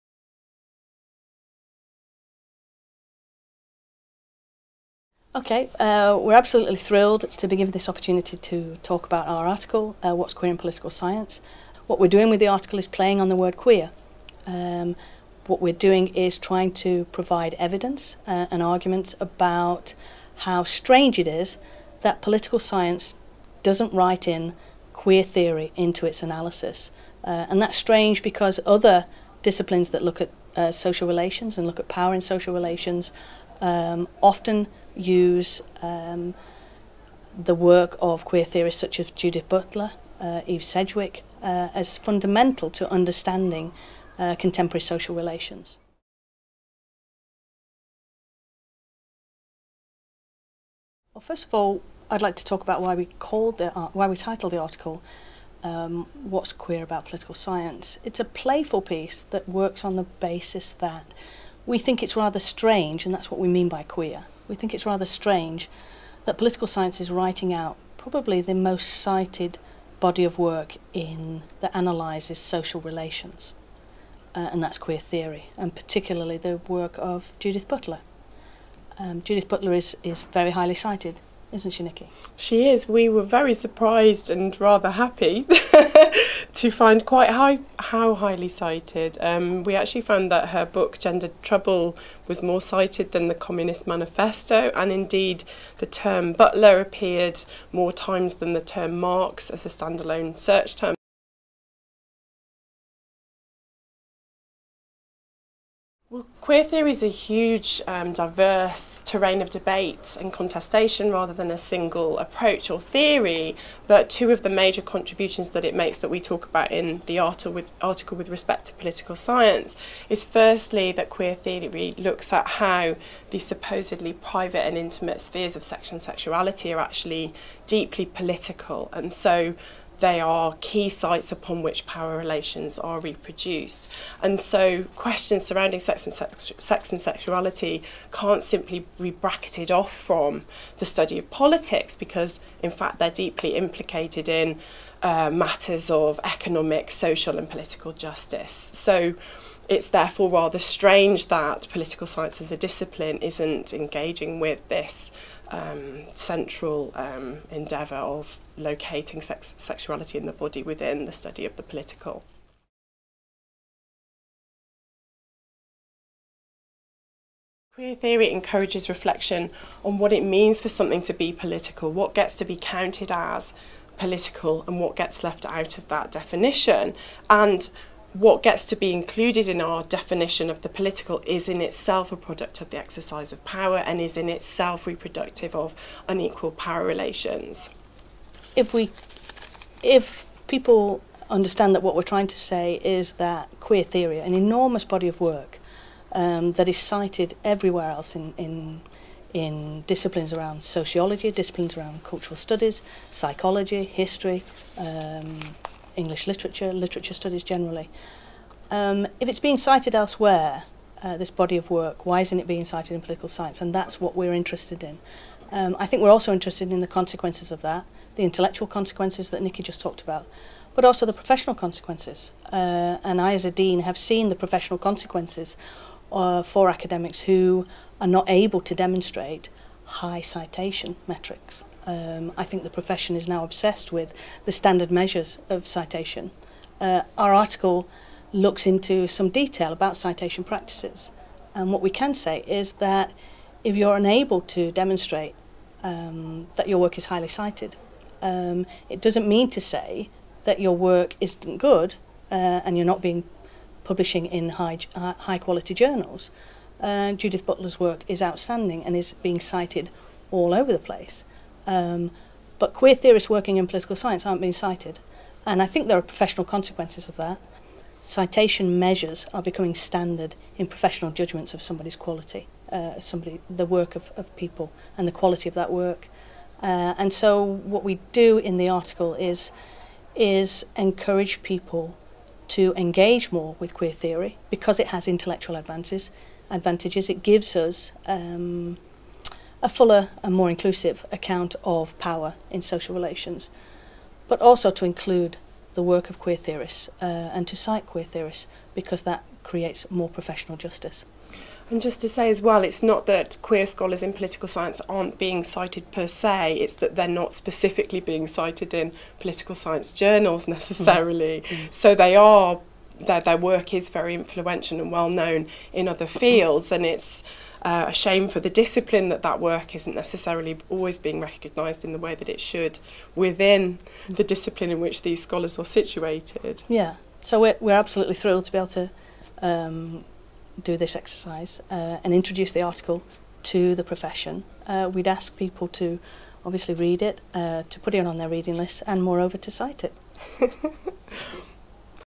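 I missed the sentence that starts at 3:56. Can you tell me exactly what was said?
Uh, our article looks into some detail about citation practices.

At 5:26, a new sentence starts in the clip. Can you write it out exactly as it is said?
Yeah, so we're, we're absolutely thrilled to be able to um, do this exercise uh, and introduce the article to the profession.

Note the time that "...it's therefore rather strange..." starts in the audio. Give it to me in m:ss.
2:29.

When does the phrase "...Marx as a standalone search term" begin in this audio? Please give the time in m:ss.
1:38.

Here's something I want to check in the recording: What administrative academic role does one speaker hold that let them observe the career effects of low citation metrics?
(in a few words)
Dean.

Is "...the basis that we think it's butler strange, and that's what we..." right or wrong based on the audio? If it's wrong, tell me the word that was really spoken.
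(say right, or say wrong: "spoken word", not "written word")
wrong: "rather", not "butler".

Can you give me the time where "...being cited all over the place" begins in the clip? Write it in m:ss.
4:19.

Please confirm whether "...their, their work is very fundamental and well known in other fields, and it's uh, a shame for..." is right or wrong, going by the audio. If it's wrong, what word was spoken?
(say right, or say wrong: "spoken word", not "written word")
wrong: "influential", not "fundamental".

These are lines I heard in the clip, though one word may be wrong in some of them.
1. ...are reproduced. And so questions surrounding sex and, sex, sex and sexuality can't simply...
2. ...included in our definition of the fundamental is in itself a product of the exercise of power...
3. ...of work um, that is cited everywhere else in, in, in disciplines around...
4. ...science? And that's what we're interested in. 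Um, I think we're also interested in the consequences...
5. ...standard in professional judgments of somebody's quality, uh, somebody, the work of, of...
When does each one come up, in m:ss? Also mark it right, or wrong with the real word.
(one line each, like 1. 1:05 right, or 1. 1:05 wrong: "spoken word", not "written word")
1. 2:12 right
2. 2:58 wrong: "political", not "fundamental"
3. 3:15 right
4. 3:33 right
5. 4:29 right.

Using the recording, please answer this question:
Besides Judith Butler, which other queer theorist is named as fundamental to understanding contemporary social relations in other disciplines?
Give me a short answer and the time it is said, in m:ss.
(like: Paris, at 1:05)
Eve Sedgwick, at 0:40.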